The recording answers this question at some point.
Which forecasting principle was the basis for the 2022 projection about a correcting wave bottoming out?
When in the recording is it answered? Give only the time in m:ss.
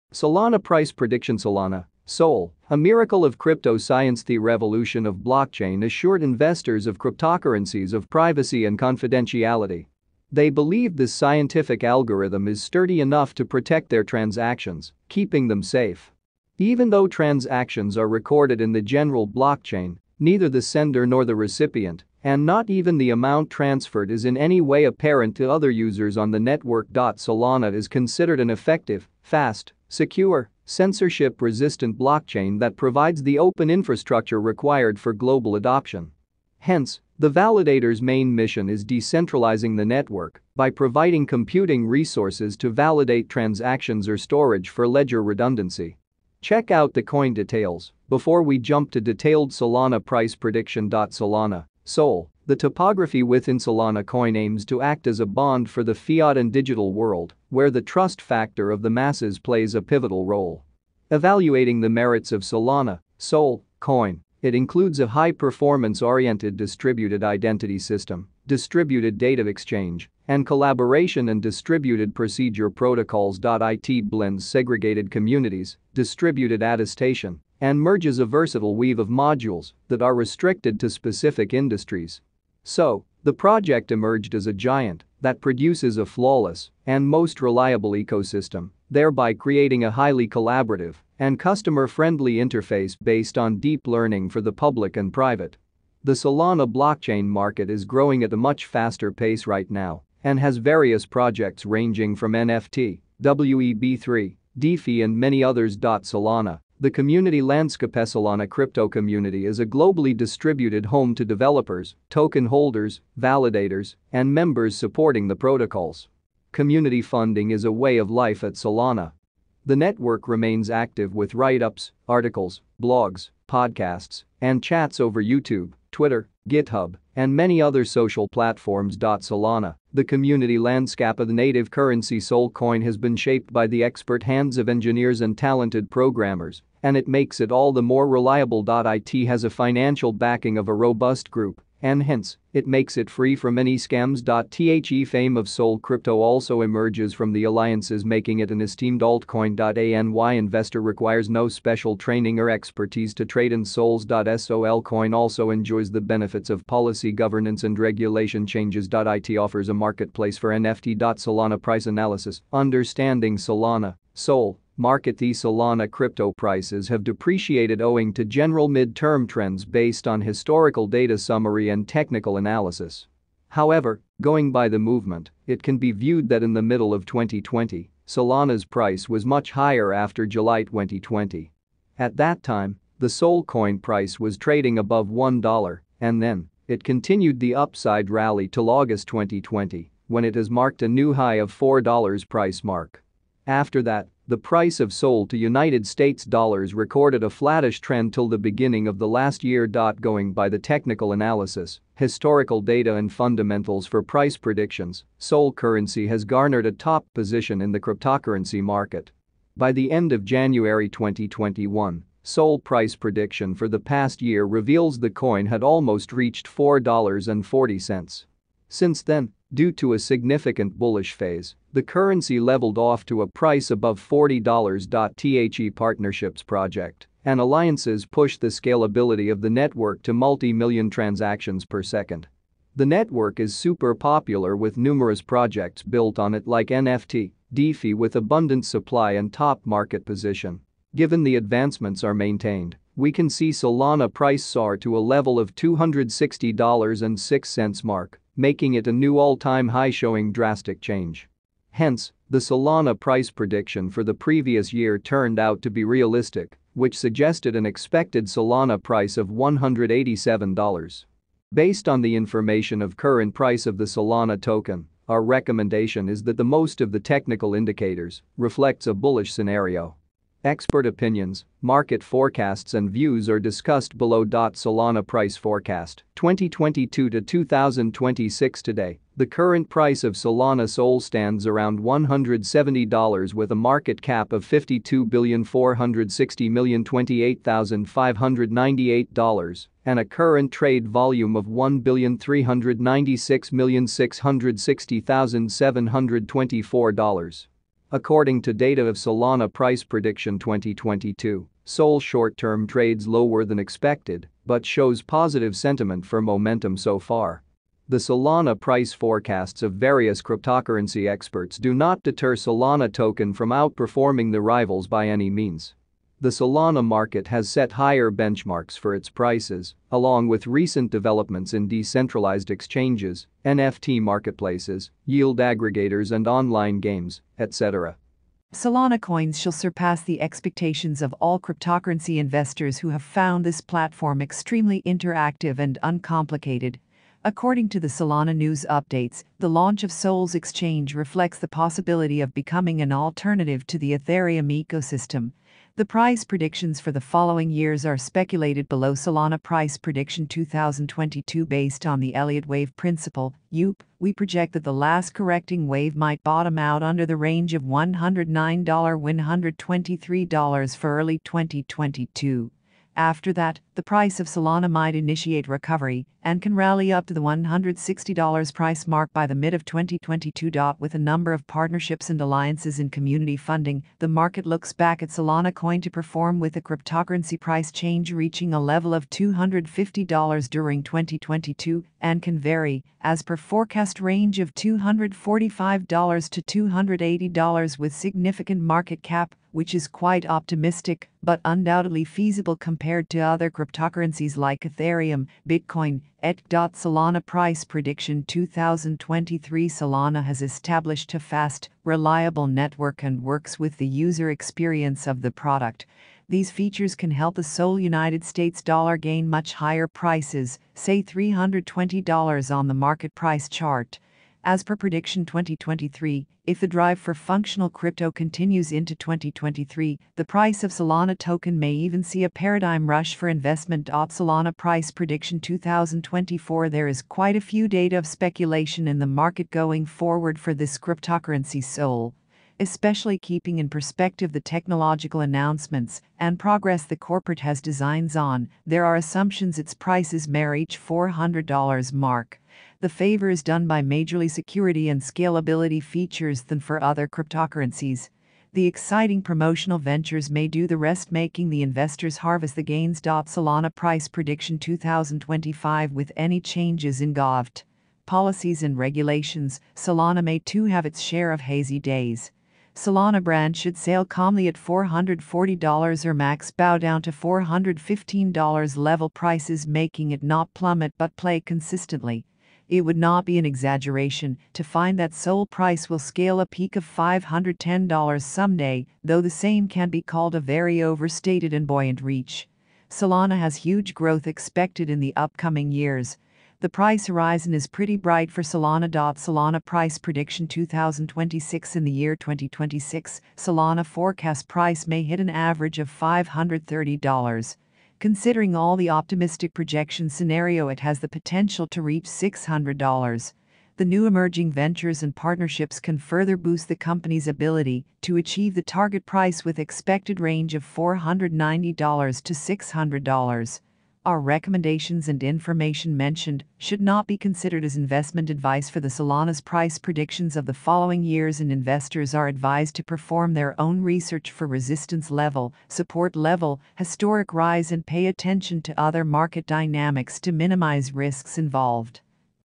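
5:52.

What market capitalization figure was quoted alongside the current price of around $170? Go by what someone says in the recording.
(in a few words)
$52,460,028,598.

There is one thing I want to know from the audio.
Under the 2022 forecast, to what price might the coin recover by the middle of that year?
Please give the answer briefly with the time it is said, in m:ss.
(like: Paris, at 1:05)
$160, at 6:07.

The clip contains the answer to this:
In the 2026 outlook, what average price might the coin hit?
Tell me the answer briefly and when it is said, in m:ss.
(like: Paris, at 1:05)
$530, at 8:15.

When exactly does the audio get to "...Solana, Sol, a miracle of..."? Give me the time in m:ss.
0:01.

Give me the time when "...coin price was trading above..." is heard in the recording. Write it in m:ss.
3:03.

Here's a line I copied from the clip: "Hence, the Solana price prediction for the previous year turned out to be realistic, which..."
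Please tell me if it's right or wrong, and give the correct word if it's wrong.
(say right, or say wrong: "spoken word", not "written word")
right.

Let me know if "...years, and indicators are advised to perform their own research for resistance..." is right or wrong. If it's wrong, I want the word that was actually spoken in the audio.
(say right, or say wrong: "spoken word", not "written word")
wrong: "investors", not "indicators".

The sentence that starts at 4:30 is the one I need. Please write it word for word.
Expert opinions, market forecasts and views are discussed below.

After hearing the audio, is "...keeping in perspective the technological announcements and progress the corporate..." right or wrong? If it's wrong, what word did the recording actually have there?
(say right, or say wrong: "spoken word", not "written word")
right.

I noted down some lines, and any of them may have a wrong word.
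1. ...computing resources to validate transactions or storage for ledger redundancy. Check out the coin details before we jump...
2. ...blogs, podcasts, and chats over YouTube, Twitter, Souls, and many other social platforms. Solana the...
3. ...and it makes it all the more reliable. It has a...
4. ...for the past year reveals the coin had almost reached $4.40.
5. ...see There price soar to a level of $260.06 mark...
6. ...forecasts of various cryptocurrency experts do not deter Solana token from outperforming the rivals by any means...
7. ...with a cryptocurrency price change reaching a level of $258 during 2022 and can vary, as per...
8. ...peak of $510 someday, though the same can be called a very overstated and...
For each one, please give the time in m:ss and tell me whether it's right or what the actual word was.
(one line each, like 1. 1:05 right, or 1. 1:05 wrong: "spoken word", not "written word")
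1. 0:41 right
2. 2:02 wrong: "GitHub", not "Souls"
3. 2:16 right
4. 3:33 right
5. 4:03 wrong: "Solana", not "There"
6. 5:08 right
7. 6:16 wrong: "250", not "258"
8. 7:56 right.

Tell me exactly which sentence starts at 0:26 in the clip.
Solana is considered an effective, fast, secure, censorship-resistant blockchain that provides the open infrastructure required for global adoption.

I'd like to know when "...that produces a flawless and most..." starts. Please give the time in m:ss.
1:25.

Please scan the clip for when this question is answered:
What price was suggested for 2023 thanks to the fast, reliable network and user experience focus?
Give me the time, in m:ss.
6:51.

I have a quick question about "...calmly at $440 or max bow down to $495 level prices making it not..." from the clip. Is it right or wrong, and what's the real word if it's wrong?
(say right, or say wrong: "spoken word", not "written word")
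wrong: "415", not "495".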